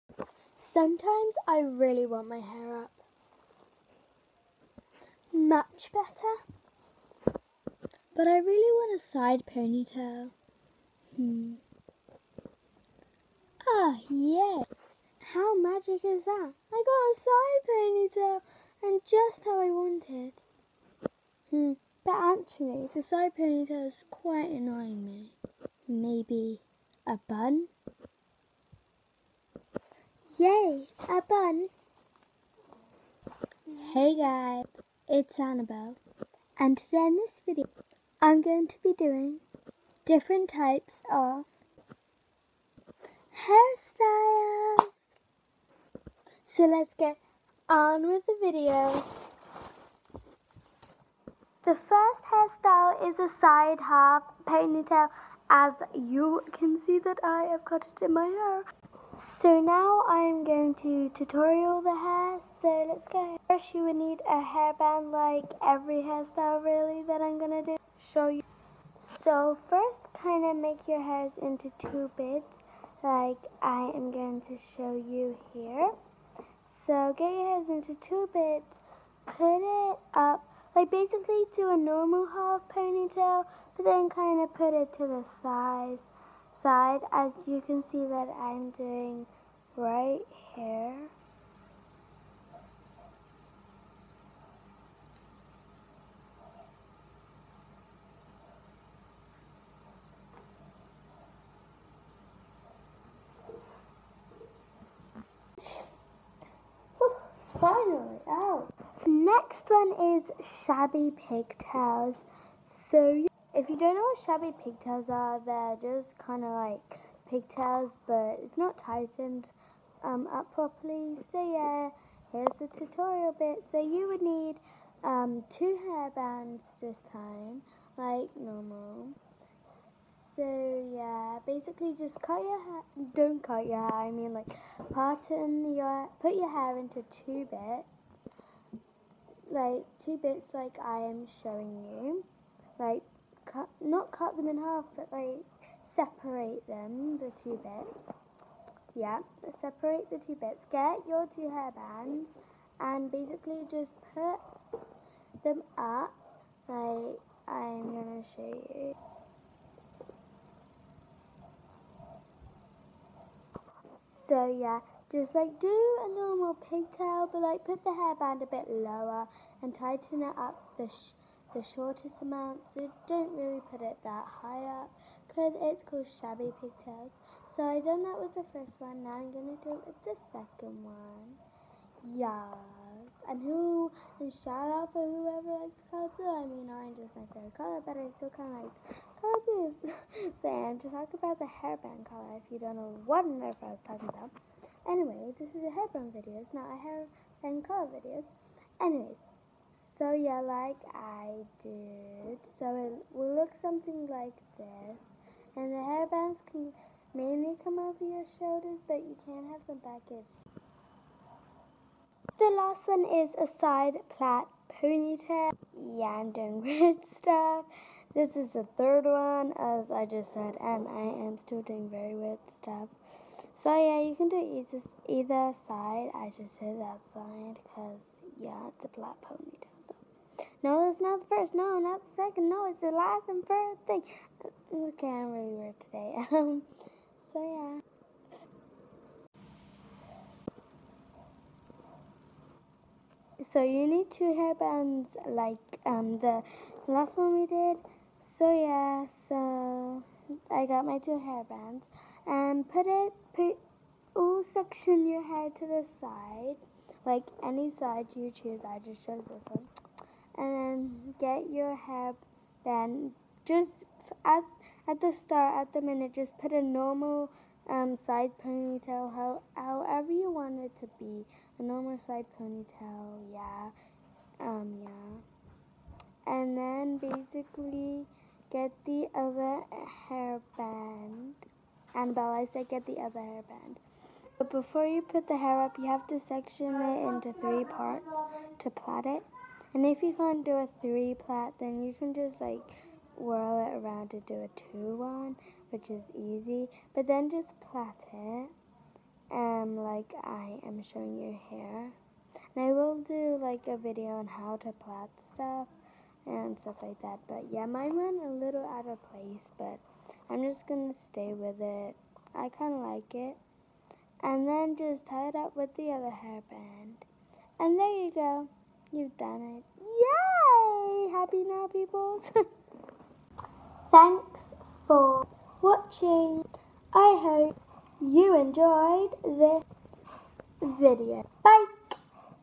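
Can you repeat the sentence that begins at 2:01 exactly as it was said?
So yeah, here's the tutorial bit.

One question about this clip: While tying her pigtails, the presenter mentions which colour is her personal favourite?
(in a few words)
Orange.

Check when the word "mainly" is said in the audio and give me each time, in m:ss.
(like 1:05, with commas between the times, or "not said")
3:27.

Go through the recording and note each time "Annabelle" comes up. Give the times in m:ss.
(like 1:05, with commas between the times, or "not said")
0:35, 4:41.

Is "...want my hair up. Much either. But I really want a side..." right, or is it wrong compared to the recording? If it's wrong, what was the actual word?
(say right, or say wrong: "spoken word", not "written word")
wrong: "better", not "either".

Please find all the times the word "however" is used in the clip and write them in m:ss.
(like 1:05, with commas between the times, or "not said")
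4:29.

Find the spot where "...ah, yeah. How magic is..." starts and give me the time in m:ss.
0:13.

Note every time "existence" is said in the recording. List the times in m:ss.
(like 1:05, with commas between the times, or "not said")
not said.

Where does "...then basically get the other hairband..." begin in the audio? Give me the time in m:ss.
4:36.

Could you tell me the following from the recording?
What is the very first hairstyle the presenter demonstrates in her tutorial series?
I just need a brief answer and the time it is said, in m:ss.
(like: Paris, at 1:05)
Side half ponytail, at 0:53.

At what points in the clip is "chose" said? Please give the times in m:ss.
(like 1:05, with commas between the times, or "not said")
4:19.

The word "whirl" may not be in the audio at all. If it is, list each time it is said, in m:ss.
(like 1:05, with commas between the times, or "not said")
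4:53.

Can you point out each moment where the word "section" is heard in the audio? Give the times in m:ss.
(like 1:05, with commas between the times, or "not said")
4:14, 4:46.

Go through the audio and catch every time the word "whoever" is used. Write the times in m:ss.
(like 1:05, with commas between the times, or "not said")
3:05.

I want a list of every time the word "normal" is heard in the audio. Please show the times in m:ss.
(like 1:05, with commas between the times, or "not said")
1:21, 2:08, 2:46, 4:26, 4:31.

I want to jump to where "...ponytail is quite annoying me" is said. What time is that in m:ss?
0:23.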